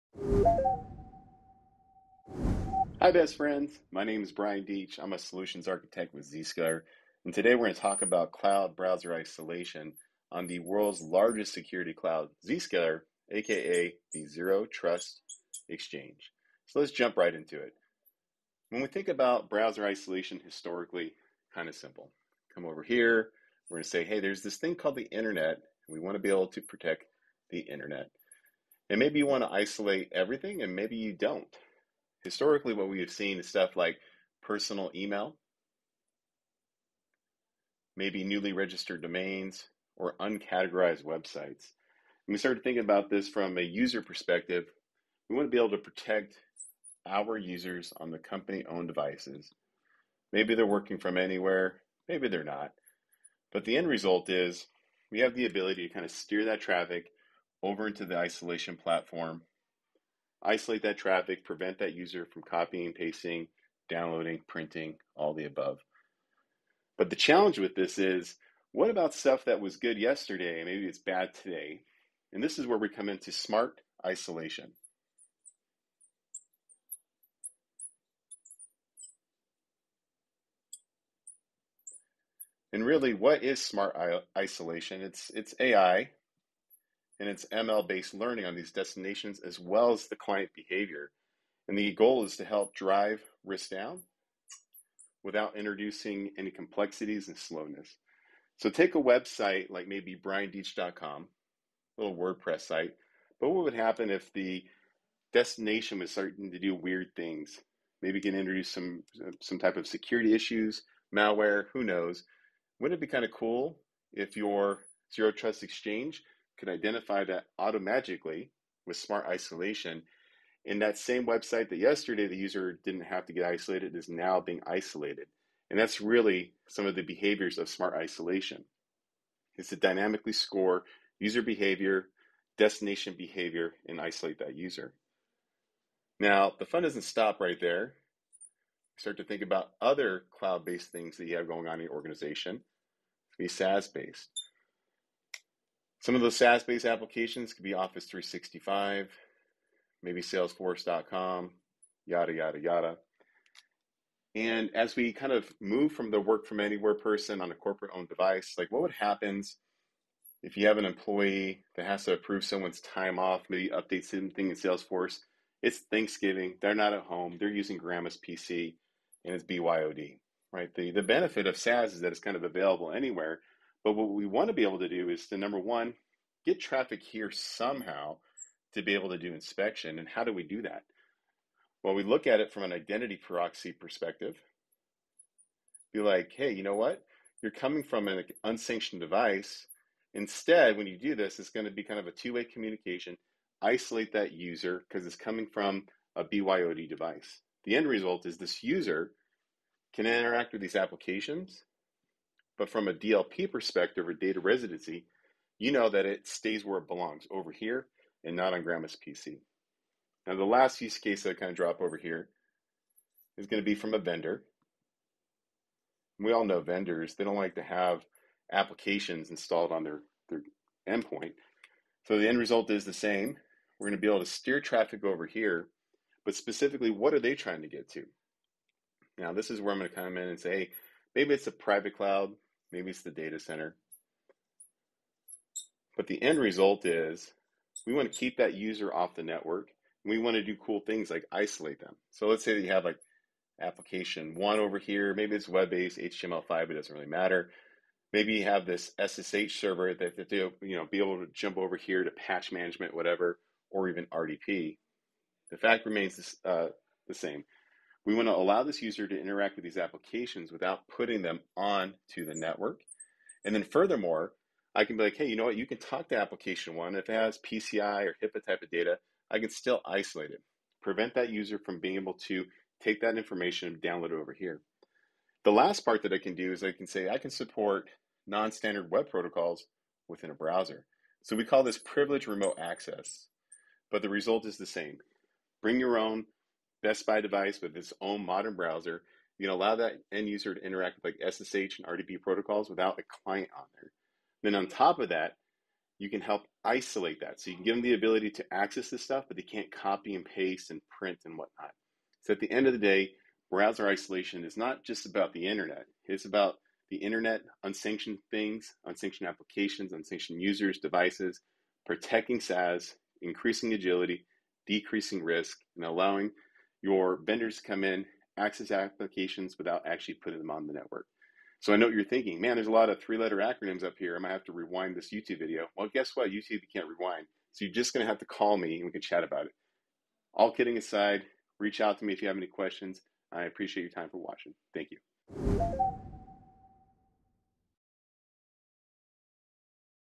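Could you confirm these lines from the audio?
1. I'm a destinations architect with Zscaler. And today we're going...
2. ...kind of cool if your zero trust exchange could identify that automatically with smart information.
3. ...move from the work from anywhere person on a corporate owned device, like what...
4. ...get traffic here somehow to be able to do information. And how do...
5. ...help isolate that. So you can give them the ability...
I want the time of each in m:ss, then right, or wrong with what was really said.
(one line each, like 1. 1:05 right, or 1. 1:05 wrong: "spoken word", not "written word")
1. 0:04 wrong: "solutions", not "destinations"
2. 1:53 wrong: "isolation", not "information"
3. 2:35 right
4. 2:56 wrong: "inspection", not "information"
5. 4:56 right.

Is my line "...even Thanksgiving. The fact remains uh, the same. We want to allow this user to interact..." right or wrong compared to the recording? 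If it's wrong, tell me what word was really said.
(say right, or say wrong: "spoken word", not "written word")
wrong: "RDP", not "Thanksgiving".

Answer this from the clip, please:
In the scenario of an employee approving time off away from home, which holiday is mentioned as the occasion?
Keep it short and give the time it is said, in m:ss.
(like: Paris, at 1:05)
Thanksgiving, at 2:45.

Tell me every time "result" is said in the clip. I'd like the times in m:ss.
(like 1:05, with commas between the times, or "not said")
0:53, 3:17, 3:42, 3:56, 4:44.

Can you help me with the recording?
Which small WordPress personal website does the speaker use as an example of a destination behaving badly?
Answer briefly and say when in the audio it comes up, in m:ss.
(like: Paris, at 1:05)
briandeitch.com, at 1:40.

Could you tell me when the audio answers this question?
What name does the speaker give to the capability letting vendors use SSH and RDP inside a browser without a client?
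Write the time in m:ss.
4:41.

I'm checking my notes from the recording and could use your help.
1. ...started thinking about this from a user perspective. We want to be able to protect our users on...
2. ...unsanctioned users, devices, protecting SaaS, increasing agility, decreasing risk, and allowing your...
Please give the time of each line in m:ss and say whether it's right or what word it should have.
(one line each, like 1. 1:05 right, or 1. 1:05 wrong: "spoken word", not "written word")
1. 0:42 right
2. 5:09 right.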